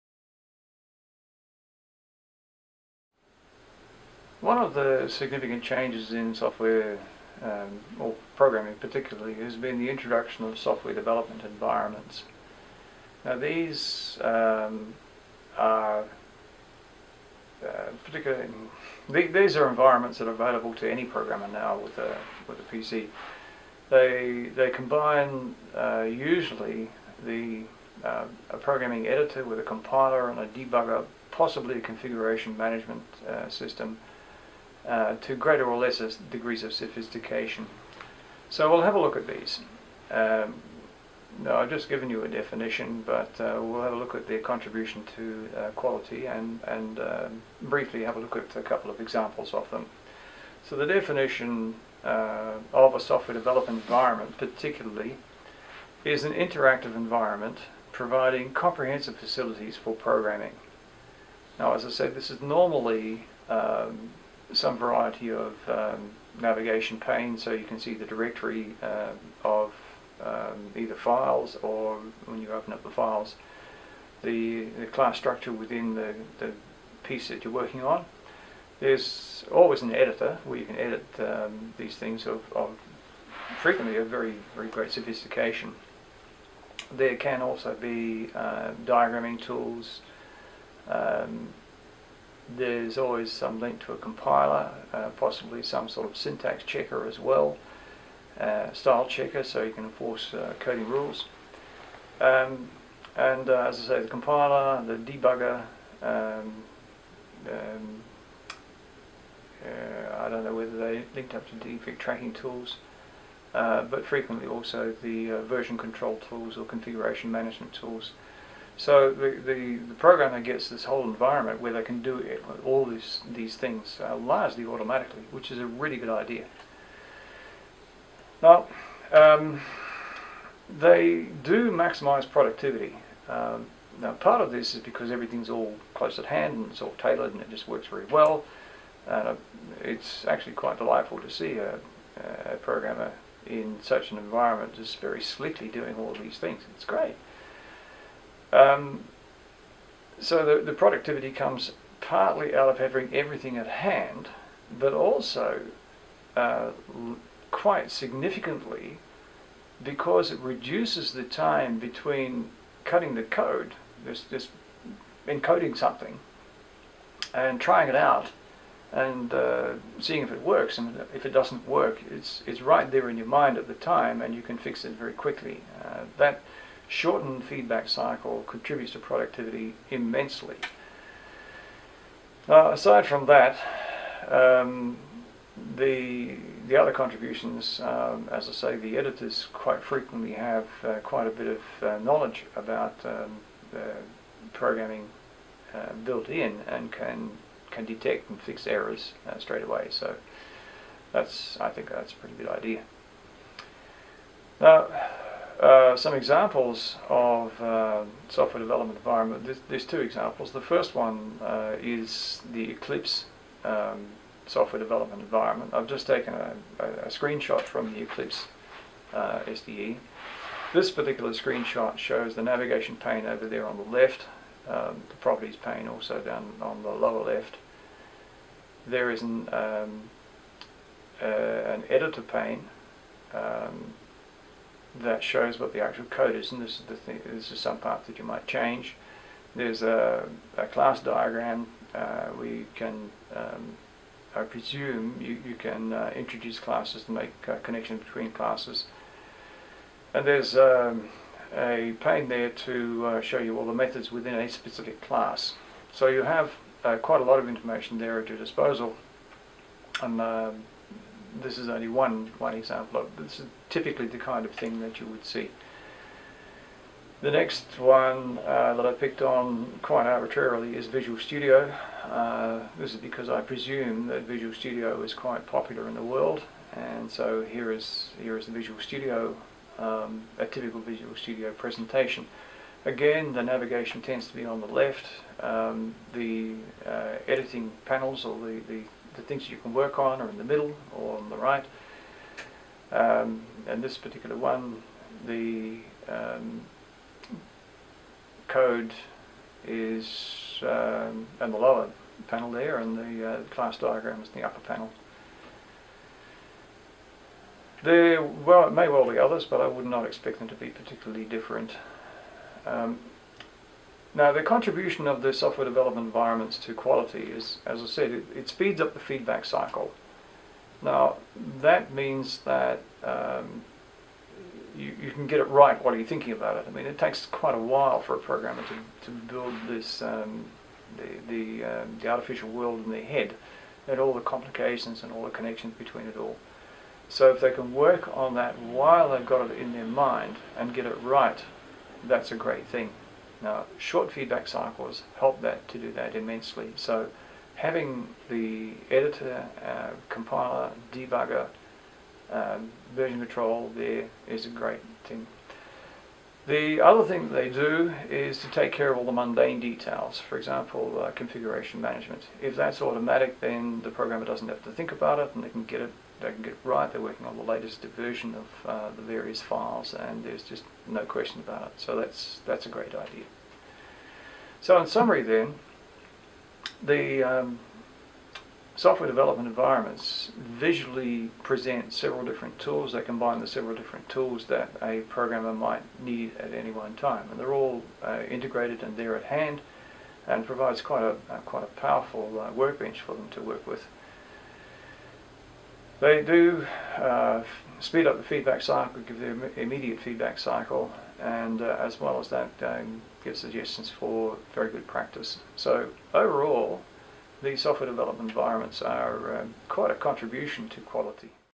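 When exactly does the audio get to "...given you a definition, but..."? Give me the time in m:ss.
0:41.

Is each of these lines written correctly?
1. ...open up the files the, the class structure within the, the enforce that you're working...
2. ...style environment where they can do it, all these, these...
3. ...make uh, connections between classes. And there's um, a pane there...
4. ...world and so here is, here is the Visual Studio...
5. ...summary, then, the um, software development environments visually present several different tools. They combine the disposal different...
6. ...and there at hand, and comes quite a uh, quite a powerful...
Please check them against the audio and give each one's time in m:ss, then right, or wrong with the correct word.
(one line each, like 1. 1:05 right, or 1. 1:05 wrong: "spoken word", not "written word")
1. 1:12 wrong: "piece", not "enforce"
2. 2:00 wrong: "whole", not "style"
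3. 4:07 right
4. 4:36 right
5. 6:14 wrong: "several", not "disposal"
6. 6:28 wrong: "provides", not "comes".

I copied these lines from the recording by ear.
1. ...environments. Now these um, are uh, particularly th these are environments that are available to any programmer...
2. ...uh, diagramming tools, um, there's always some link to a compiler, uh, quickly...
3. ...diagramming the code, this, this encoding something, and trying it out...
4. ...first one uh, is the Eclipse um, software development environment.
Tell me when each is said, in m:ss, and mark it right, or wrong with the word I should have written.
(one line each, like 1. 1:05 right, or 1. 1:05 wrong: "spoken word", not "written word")
1. 0:11 right
2. 1:28 wrong: "possibly", not "quickly"
3. 2:42 wrong: "cutting", not "diagramming"
4. 3:30 right.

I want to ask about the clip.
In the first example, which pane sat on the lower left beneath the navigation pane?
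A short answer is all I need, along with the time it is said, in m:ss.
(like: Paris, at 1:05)
properties pane, at 3:45.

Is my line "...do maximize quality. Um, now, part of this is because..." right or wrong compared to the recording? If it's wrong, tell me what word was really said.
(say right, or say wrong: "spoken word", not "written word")
wrong: "productivity", not "quality".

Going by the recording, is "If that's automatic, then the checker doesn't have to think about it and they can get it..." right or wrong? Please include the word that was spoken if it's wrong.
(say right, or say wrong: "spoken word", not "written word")
wrong: "programmer", not "checker".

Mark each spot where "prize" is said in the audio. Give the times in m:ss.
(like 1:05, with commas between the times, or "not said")
not said.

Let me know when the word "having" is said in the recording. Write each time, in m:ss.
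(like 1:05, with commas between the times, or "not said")
2:32, 5:47.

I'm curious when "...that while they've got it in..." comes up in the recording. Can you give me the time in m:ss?
5:38.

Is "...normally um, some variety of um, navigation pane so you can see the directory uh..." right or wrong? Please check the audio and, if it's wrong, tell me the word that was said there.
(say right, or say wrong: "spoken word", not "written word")
right.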